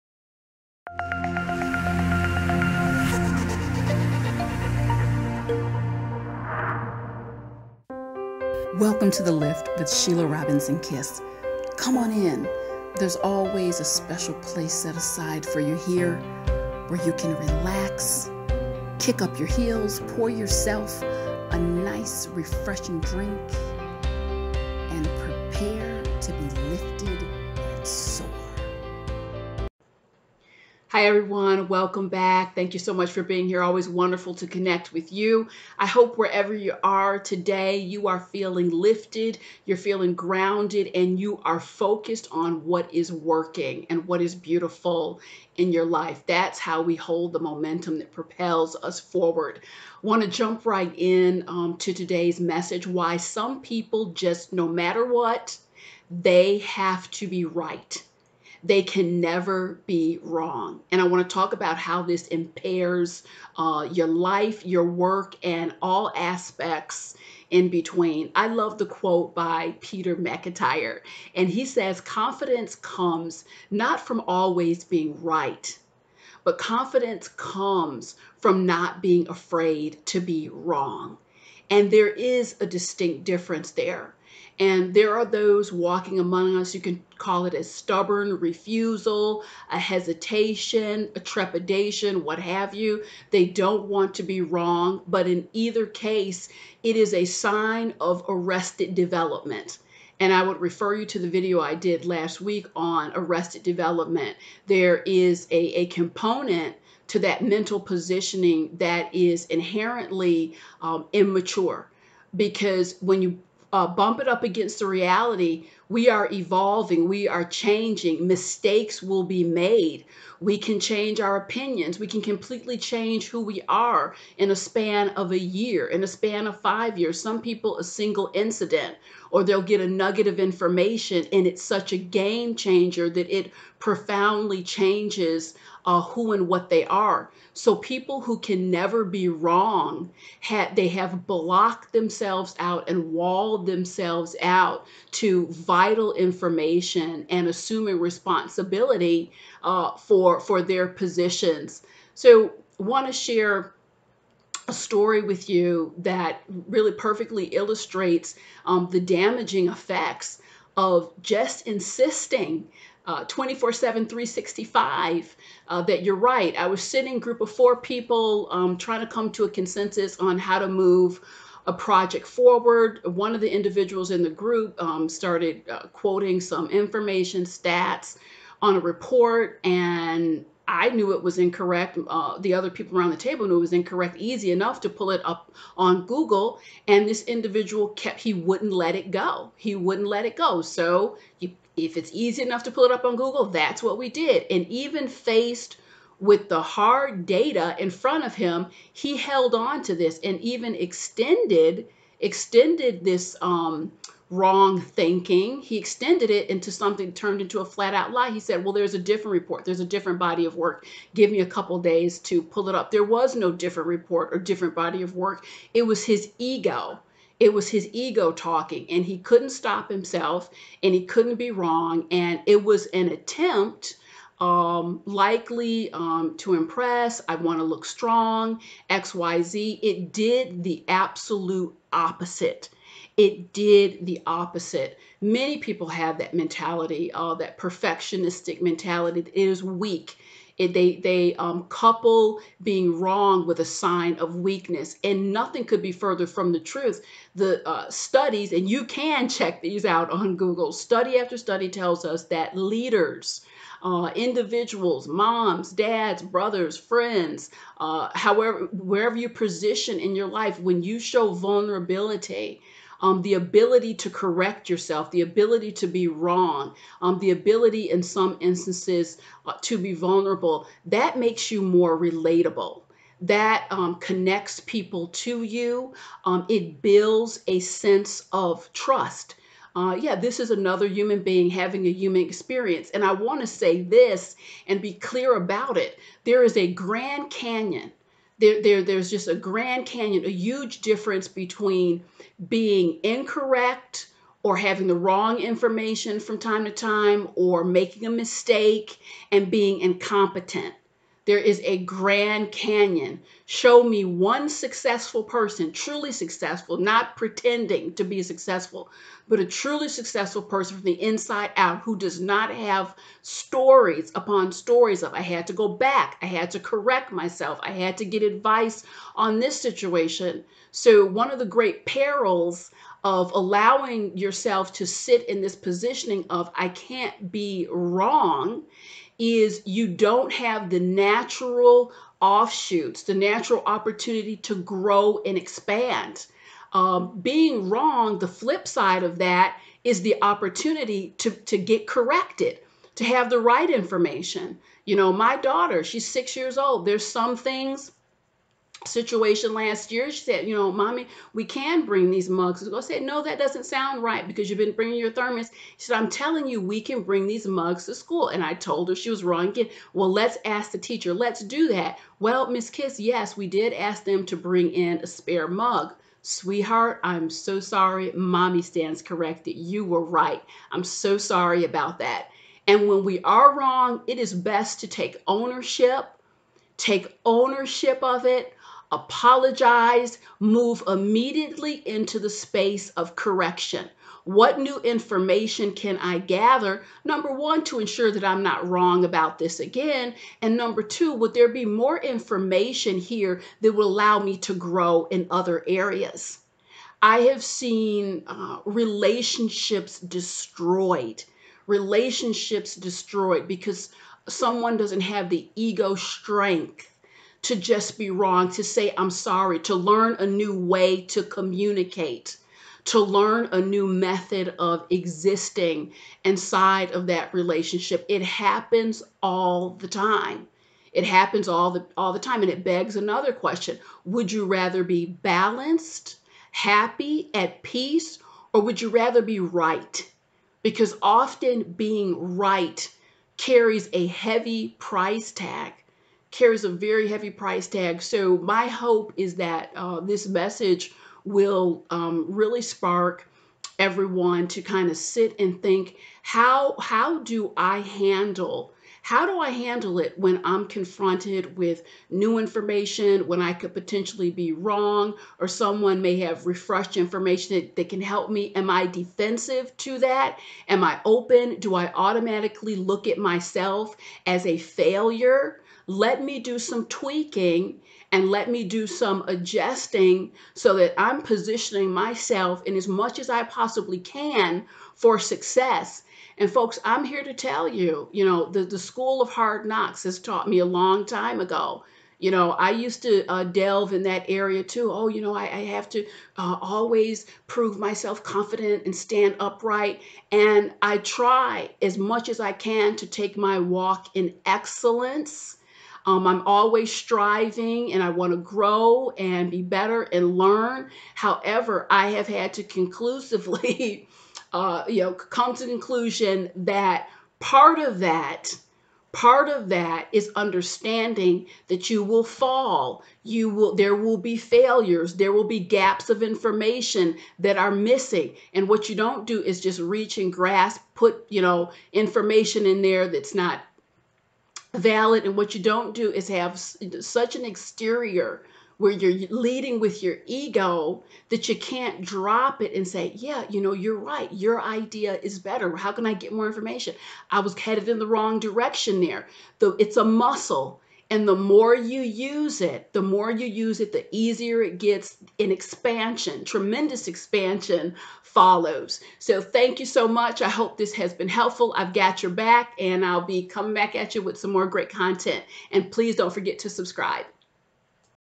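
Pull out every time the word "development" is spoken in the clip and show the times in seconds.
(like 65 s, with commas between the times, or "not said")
98 s, 103 s.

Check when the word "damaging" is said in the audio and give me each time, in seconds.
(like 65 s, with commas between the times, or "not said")
158 s.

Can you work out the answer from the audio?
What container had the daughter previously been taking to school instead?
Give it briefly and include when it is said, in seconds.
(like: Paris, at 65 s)
Thermos, at 355 s.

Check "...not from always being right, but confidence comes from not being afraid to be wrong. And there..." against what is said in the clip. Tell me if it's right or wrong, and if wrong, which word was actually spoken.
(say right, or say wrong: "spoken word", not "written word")
right.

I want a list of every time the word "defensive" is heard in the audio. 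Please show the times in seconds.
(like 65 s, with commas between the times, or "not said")
458 s.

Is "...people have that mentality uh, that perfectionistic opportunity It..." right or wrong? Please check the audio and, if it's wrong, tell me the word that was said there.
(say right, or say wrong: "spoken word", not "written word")
wrong: "mentality", not "opportunity".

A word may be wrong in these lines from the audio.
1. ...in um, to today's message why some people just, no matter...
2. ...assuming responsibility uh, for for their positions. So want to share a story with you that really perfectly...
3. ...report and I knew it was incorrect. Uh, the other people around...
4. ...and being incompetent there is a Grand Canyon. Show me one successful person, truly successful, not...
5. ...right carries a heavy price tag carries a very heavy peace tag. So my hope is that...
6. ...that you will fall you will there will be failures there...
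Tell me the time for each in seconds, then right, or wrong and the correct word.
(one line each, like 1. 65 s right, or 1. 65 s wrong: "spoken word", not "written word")
1. 50 s right
2. 147 s right
3. 178 s right
4. 299 s right
5. 432 s wrong: "price", not "peace"
6. 511 s right.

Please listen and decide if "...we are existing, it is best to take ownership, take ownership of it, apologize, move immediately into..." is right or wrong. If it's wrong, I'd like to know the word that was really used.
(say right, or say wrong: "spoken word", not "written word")
wrong: "wrong", not "existing".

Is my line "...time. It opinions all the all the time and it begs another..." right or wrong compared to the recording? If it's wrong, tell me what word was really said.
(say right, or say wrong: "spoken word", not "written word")
wrong: "happens", not "opinions".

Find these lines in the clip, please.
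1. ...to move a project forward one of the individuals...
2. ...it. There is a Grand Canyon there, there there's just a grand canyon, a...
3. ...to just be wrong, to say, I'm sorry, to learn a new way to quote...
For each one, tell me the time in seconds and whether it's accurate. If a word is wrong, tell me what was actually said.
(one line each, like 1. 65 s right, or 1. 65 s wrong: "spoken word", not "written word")
1. 170 s right
2. 285 s right
3. 407 s wrong: "communicate", not "quote".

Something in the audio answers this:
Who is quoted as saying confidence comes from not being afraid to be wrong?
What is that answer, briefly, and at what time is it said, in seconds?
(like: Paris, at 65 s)
Peter McIntyre, at 69 s.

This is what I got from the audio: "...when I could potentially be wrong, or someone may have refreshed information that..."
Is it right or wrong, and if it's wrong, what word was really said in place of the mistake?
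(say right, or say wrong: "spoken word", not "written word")
right.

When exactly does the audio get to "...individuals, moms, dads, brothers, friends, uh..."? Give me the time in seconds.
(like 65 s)
254 s.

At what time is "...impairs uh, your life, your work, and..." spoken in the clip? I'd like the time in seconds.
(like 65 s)
62 s.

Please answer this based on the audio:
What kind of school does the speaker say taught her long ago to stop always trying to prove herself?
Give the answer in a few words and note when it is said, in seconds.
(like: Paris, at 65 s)
School of hard knocks, at 478 s.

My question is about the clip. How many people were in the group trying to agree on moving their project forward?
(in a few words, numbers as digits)
4.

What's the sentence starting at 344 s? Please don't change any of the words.
You know, my daughter, she's six years old.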